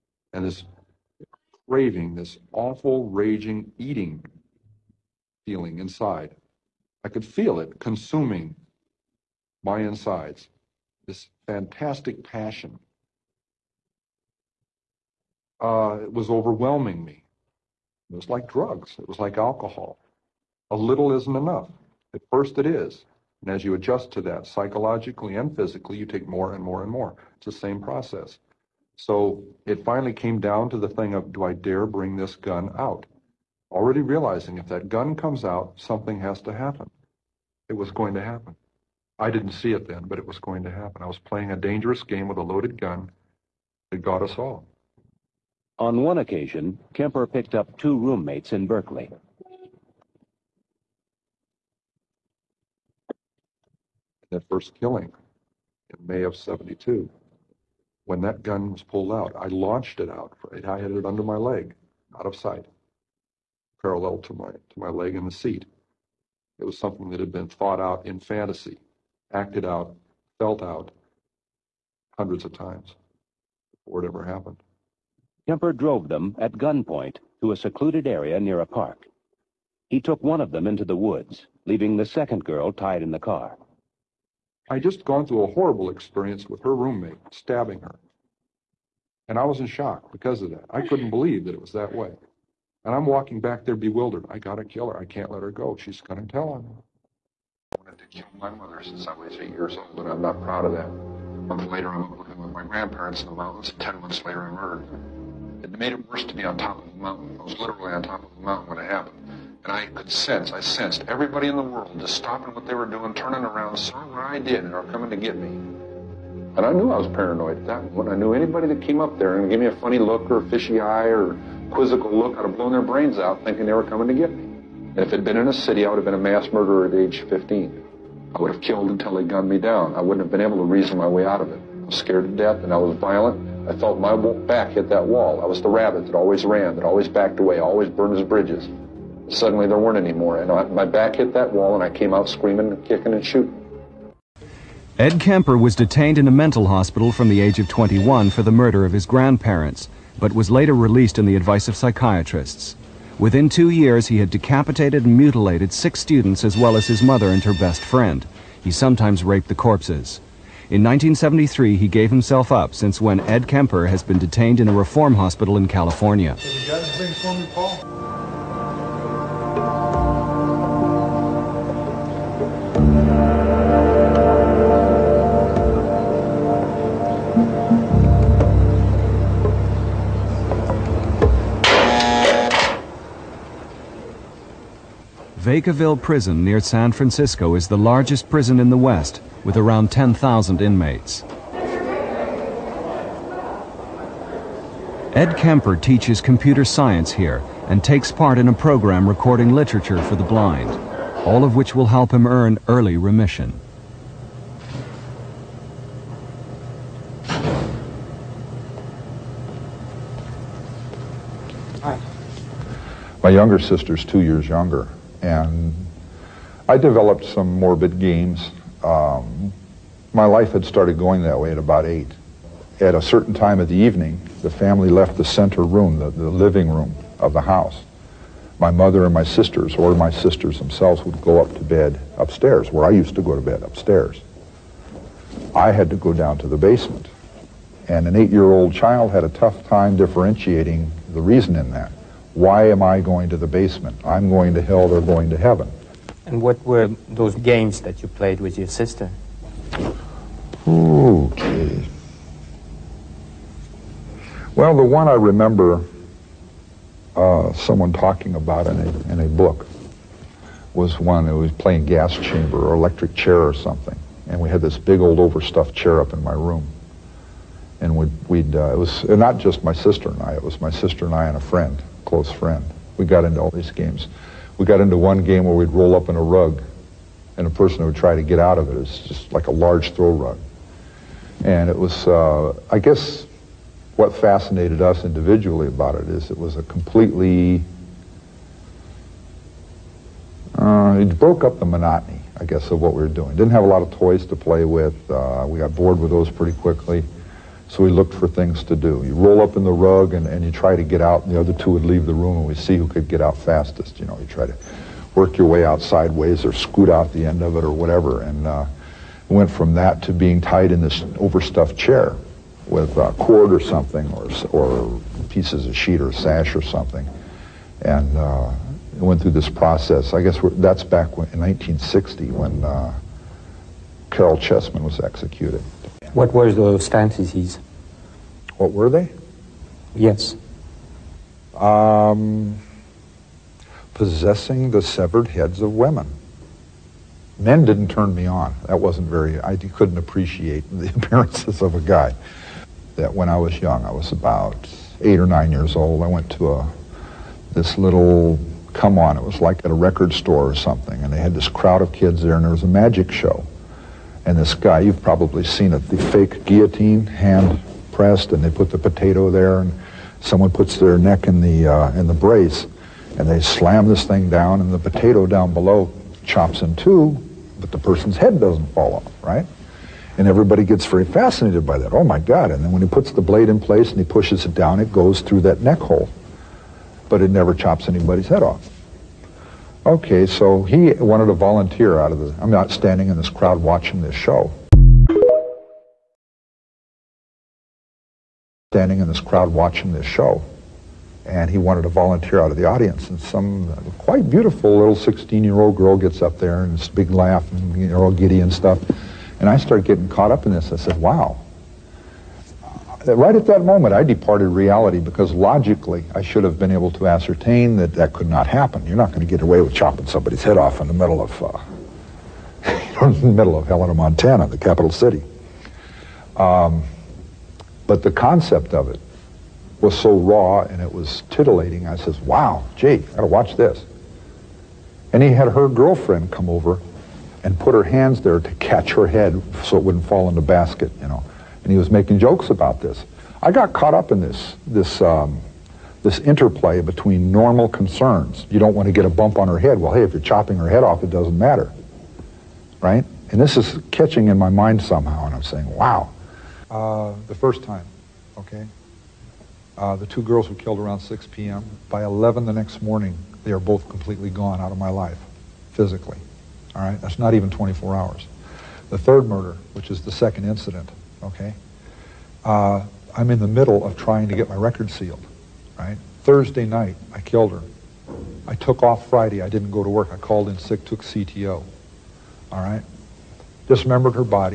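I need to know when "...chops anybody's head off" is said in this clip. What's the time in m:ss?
6:17.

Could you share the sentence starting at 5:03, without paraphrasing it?
You know, you try to work your way out sideways or scoot out the end of it or whatever.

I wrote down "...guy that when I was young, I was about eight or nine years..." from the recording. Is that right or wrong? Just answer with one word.
right.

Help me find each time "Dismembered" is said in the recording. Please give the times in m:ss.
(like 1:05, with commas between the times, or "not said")
7:53.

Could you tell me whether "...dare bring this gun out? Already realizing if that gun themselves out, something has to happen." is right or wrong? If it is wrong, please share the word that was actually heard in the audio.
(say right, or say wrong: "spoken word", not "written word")
wrong: "comes", not "themselves".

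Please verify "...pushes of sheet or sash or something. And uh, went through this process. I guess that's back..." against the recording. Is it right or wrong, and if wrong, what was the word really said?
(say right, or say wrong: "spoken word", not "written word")
wrong: "pieces", not "pushes".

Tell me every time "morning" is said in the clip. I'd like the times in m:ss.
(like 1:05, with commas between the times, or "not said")
7:32.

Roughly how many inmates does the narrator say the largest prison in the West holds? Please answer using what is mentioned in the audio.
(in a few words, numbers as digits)
10,000.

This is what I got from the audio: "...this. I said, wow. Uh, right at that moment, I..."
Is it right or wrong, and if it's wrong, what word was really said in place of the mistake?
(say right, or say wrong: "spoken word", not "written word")
right.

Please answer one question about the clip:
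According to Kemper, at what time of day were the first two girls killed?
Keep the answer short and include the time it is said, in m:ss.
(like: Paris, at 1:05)
6 p.m., at 7:30.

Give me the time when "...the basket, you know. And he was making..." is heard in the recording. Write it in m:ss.
7:10.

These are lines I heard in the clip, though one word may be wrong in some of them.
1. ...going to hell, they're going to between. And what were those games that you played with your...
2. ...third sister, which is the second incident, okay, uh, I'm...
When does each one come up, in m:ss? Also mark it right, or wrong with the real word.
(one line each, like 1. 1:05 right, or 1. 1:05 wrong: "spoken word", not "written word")
1. 4:04 wrong: "heaven", not "between"
2. 7:38 wrong: "murder", not "sister".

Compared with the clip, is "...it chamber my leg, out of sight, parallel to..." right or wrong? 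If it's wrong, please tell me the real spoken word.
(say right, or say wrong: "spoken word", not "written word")
wrong: "under", not "chamber".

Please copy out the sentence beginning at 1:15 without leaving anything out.
Kemper drove them at gunpoint to a secluded area near a park.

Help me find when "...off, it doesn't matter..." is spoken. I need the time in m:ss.
7:20.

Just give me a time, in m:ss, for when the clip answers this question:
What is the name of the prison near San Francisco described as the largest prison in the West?
3:05.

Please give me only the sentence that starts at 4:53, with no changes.
Didn't have a lot of toys to play with.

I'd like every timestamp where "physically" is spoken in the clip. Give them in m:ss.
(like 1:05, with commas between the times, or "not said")
0:25, 7:35.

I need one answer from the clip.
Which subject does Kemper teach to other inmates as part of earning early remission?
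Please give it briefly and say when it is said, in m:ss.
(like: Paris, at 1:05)
computer science, at 3:16.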